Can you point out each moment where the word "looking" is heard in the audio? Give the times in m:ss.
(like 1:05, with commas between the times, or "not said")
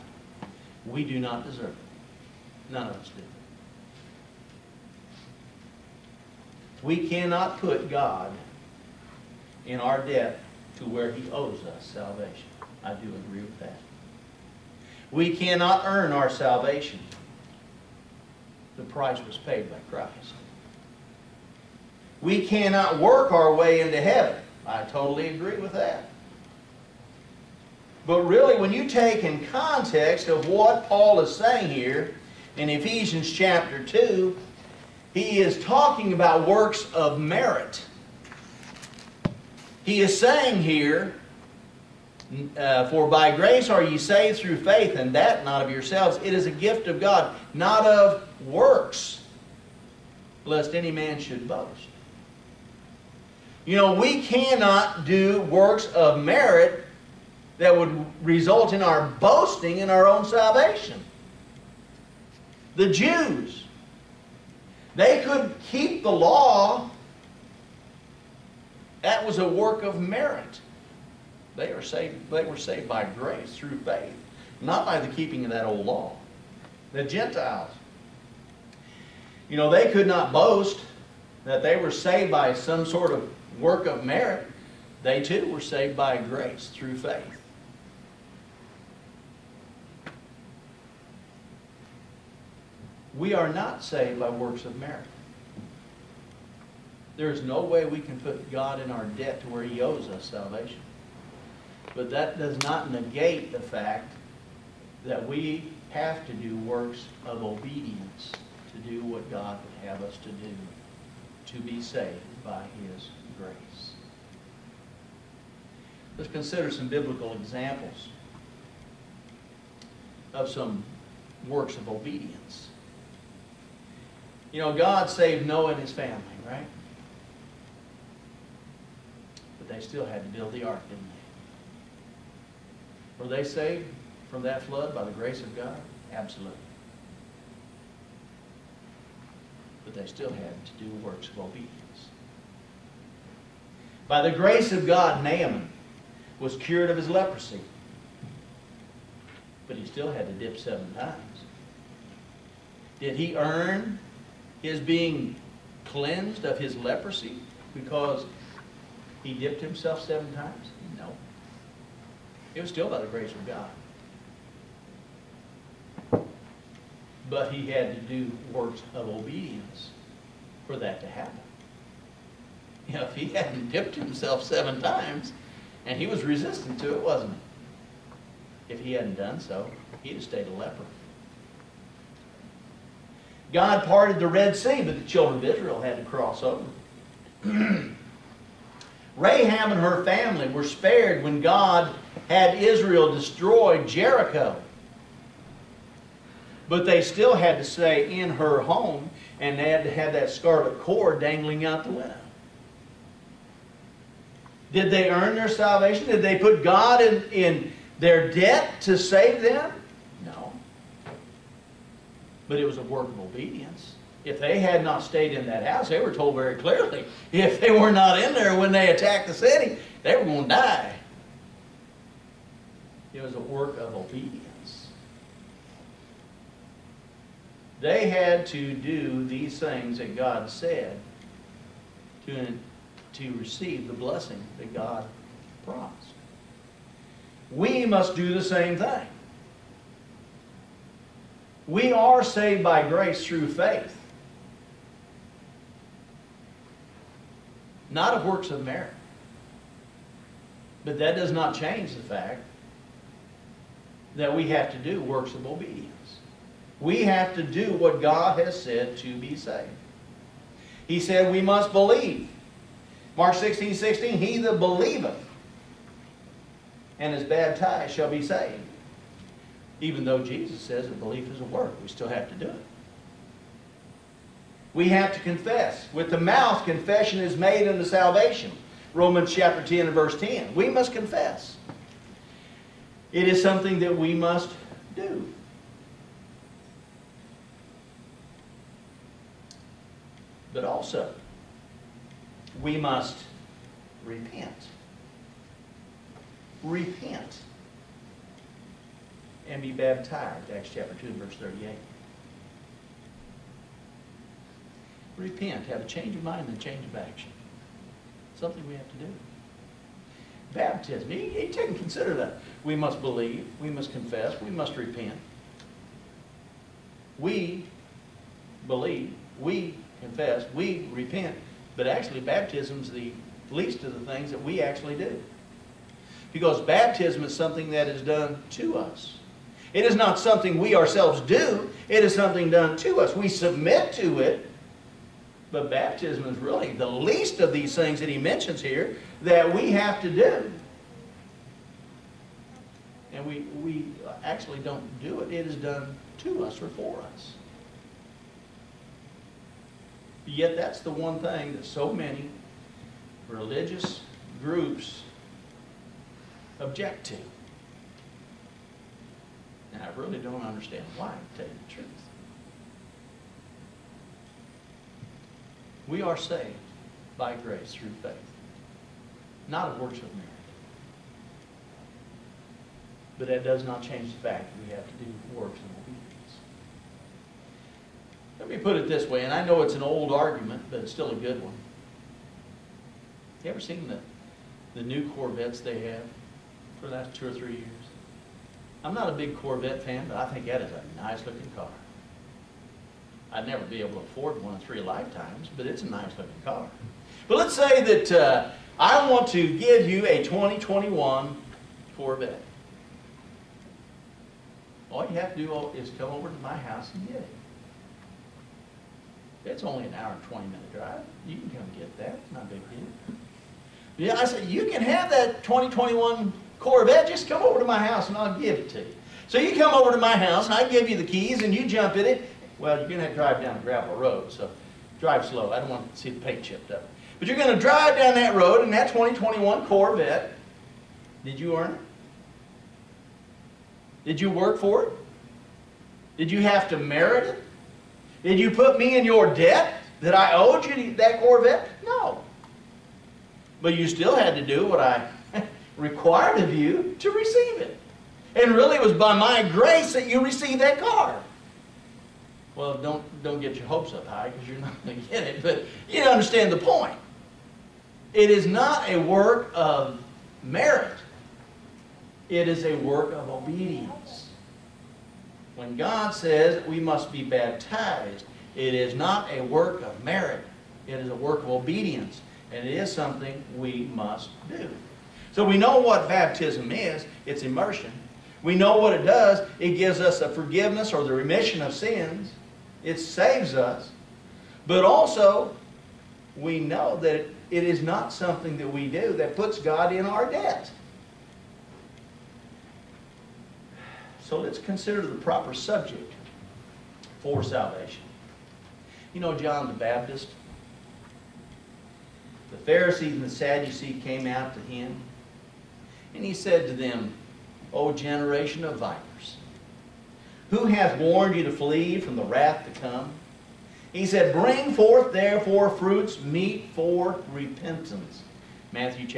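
6:31, 6:36.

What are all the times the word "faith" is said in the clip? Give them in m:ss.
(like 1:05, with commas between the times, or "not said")
0:44, 1:13, 1:26, 4:03, 6:08.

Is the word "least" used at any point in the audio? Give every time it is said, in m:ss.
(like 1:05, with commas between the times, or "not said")
5:23, 5:36.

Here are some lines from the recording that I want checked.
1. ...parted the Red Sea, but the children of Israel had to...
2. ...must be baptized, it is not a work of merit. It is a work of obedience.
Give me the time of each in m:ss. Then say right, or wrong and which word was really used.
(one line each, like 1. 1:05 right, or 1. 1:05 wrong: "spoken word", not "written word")
1. 3:03 right
2. 7:46 right.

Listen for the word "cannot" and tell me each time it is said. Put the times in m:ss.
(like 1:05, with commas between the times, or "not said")
0:07, 0:15, 0:22, 0:54.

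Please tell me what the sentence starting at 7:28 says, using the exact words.
And really it was by my grace that you received that car.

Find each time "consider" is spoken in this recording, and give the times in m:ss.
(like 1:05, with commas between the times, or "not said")
1:56, 5:11, 8:14.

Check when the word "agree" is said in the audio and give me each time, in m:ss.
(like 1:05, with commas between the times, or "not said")
0:13, 0:25.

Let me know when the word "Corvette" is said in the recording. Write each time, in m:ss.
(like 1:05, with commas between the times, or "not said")
6:25, 6:29, 6:41, 6:56, 7:09, 7:21.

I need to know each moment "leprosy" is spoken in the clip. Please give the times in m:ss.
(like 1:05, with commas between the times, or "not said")
2:27, 2:36.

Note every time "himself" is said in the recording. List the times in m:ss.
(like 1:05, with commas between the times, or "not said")
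2:39, 2:53.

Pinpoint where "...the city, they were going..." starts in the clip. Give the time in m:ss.
3:39.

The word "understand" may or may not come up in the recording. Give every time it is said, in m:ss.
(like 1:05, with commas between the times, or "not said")
6:00, 7:36.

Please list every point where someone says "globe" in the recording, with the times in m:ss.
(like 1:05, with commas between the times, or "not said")
not said.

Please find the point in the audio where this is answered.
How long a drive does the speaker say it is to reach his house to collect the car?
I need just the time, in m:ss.
6:49.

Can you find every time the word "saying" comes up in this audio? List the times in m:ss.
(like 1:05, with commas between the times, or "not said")
0:31, 0:40.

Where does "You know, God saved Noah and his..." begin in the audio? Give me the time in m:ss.
2:04.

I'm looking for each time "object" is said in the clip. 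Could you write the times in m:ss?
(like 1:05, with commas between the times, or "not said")
5:56.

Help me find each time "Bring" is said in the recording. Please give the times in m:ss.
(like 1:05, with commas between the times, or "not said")
8:34.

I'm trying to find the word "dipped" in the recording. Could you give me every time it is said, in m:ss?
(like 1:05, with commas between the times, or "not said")
2:39, 2:53.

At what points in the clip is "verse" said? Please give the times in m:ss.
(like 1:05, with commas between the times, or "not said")
4:39, 5:01.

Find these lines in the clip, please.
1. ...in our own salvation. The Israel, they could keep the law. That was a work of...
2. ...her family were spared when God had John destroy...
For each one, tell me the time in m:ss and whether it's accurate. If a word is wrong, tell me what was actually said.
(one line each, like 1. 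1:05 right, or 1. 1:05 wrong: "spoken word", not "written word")
1. 0:59 wrong: "Jews", not "Israel"
2. 3:09 wrong: "Israel", not "John".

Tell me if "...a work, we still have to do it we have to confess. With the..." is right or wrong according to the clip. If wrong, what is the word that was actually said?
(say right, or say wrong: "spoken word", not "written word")
right.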